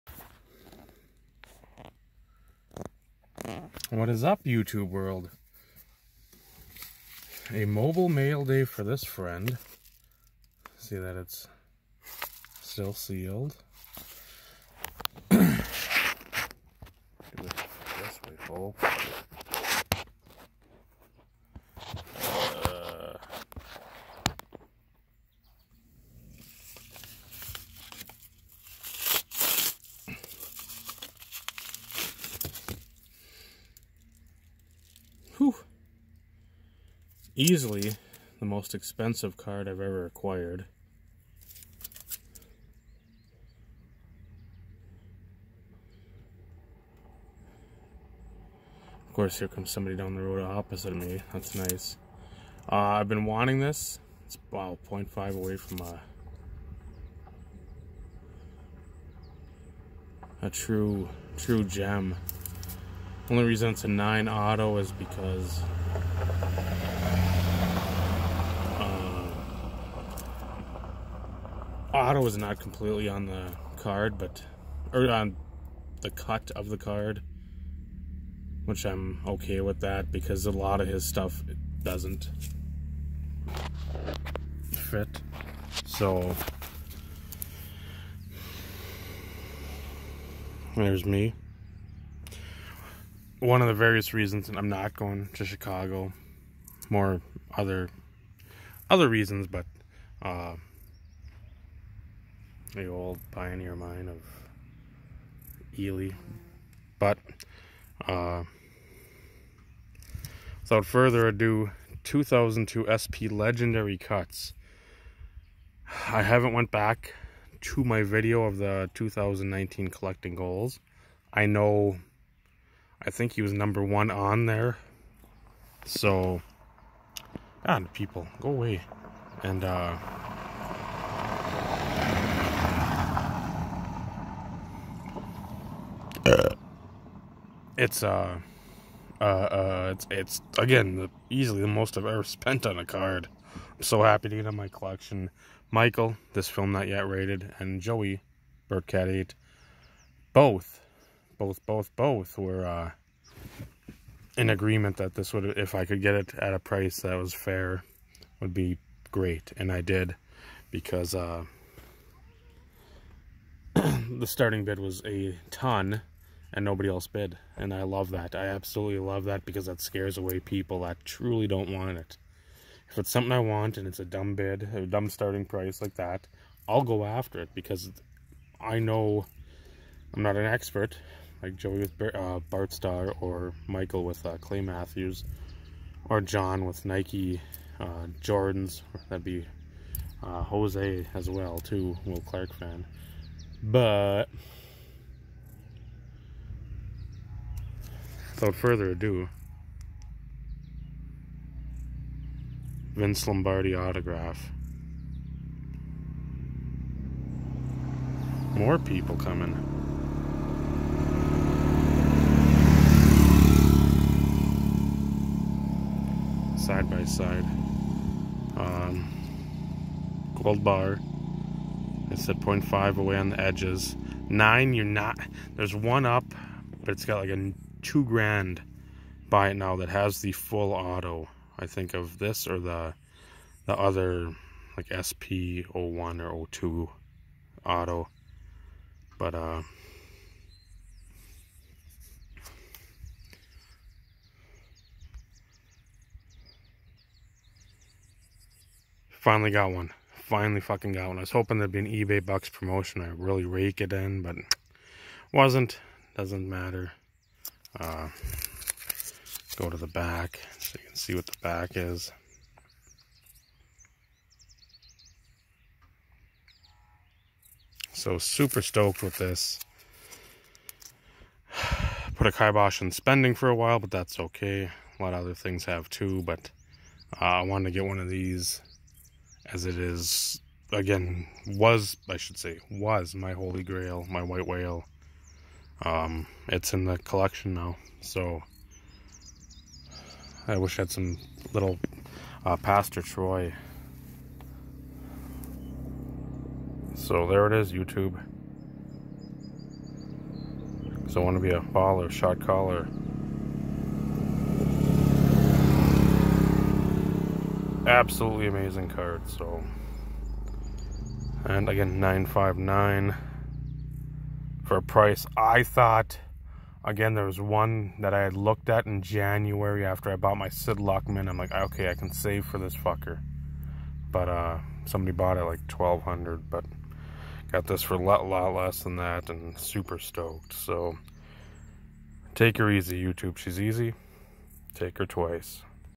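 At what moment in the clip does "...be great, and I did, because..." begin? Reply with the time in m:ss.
2:38.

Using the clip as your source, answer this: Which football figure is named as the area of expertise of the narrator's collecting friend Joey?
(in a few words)
Bart Starr.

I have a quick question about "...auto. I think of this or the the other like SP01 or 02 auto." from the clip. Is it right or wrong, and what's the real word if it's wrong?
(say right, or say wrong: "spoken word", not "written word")
right.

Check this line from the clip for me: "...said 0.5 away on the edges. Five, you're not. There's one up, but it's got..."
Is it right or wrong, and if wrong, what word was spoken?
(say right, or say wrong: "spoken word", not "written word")
wrong: "Nine", not "Five".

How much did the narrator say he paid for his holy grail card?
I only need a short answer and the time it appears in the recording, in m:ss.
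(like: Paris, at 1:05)
959, at 5:11.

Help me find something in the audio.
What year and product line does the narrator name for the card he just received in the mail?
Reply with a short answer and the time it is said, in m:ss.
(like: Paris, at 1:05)
2002 SP Legendary Cuts, at 1:52.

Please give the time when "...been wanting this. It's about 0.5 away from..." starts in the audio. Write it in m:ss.
0:53.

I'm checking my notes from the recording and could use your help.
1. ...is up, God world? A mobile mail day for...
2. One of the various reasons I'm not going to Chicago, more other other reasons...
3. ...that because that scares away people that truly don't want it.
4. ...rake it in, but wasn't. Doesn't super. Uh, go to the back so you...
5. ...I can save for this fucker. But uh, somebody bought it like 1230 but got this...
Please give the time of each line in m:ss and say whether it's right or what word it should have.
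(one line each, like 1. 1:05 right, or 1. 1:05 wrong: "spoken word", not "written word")
1. 0:04 wrong: "YouTube", not "God"
2. 1:33 right
3. 2:49 right
4. 4:13 wrong: "matter", not "super"
5. 5:21 wrong: "1200", not "1230".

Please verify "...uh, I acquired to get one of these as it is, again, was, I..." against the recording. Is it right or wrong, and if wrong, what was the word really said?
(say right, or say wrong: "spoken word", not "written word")
wrong: "wanted", not "acquired".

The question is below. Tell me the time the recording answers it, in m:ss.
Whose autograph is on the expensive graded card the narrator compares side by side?
3:22.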